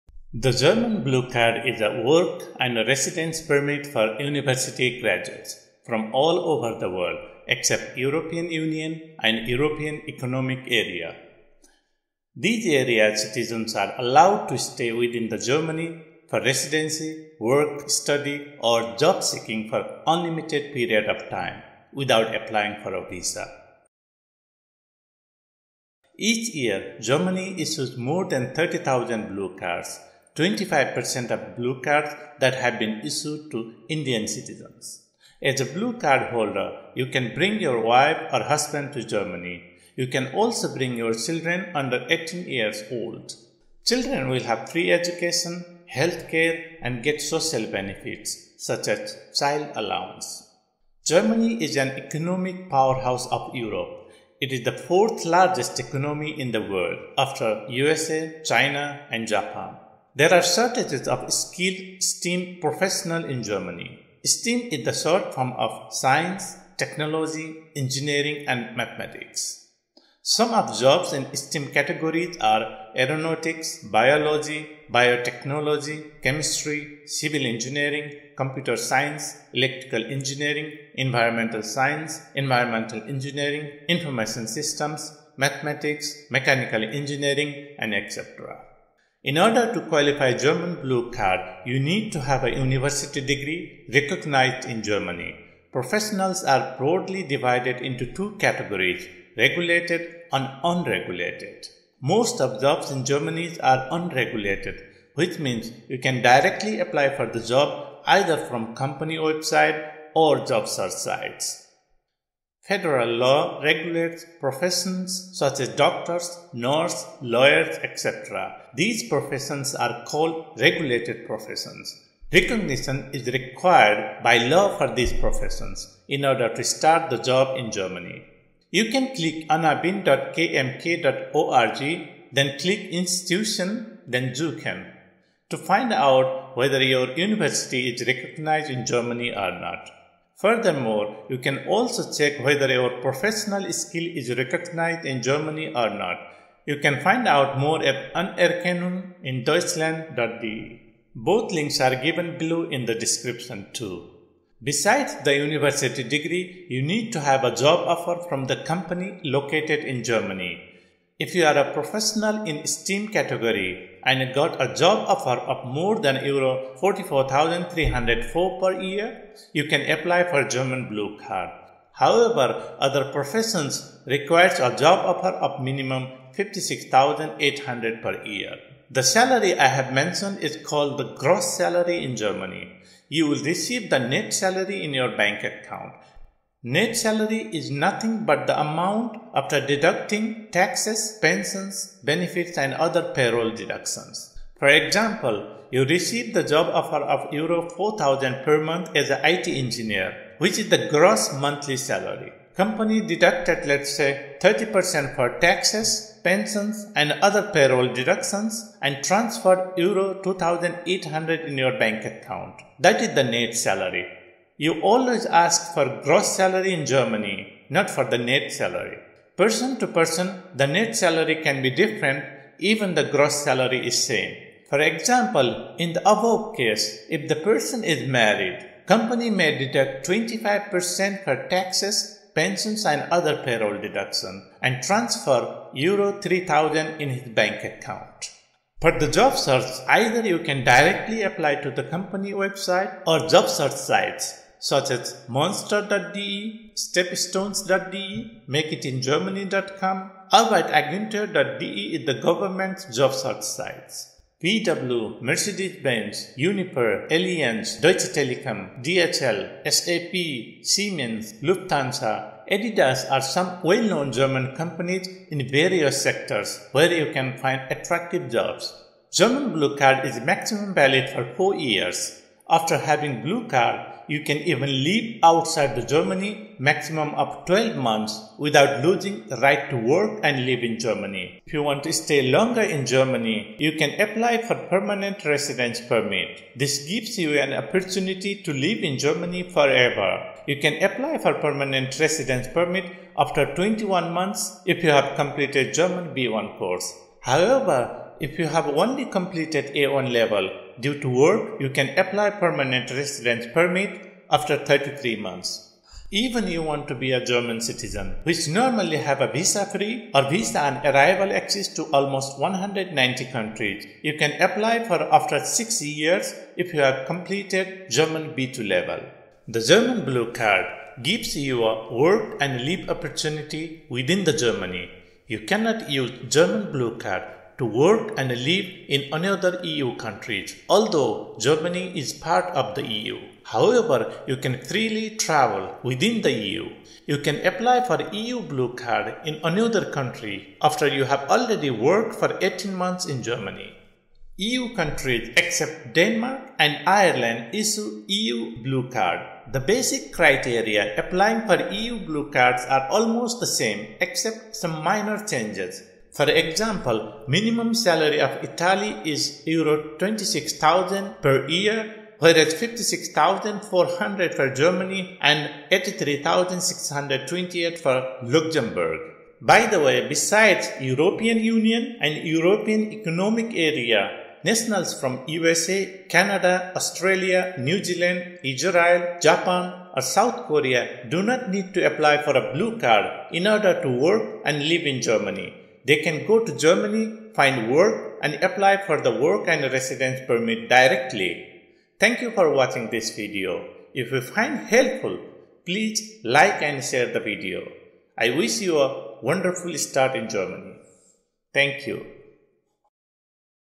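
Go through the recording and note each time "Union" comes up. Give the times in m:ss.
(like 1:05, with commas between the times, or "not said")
0:08, 6:11.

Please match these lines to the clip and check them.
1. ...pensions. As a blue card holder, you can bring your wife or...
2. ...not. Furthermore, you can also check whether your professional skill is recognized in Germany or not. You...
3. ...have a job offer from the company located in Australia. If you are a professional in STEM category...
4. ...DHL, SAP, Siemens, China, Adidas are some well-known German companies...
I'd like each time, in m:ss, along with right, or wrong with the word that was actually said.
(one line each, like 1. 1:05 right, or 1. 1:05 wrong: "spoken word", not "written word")
1. 0:34 wrong: "citizens", not "pensions"
2. 2:19 right
3. 2:37 wrong: "Germany", not "Australia"
4. 4:18 wrong: "Lufthansa", not "China".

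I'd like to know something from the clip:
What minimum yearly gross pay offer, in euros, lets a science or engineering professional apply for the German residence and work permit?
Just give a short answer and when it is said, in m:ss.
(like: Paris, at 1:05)
44,304 euros, at 2:46.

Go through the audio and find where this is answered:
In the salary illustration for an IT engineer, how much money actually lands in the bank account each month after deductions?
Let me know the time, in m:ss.
3:29.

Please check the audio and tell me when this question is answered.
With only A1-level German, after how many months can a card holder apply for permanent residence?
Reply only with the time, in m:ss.
5:04.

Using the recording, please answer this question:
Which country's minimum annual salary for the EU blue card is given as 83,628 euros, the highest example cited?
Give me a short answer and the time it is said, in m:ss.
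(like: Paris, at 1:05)
Luxembourg, at 6:08.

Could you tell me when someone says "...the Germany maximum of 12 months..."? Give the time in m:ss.
4:35.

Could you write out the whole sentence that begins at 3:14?
For example, you receive the job offer of Euro 4000 per month as an IT engineer, which is the gross monthly salary.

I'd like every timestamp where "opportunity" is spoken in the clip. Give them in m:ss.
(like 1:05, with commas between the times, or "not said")
4:47, 5:22.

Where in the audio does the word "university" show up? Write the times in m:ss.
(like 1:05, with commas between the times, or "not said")
0:04, 1:32, 2:17, 2:35.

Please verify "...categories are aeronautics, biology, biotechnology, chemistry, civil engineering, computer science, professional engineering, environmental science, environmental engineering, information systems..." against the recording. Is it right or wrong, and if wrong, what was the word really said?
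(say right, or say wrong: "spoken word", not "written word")
wrong: "electrical", not "professional".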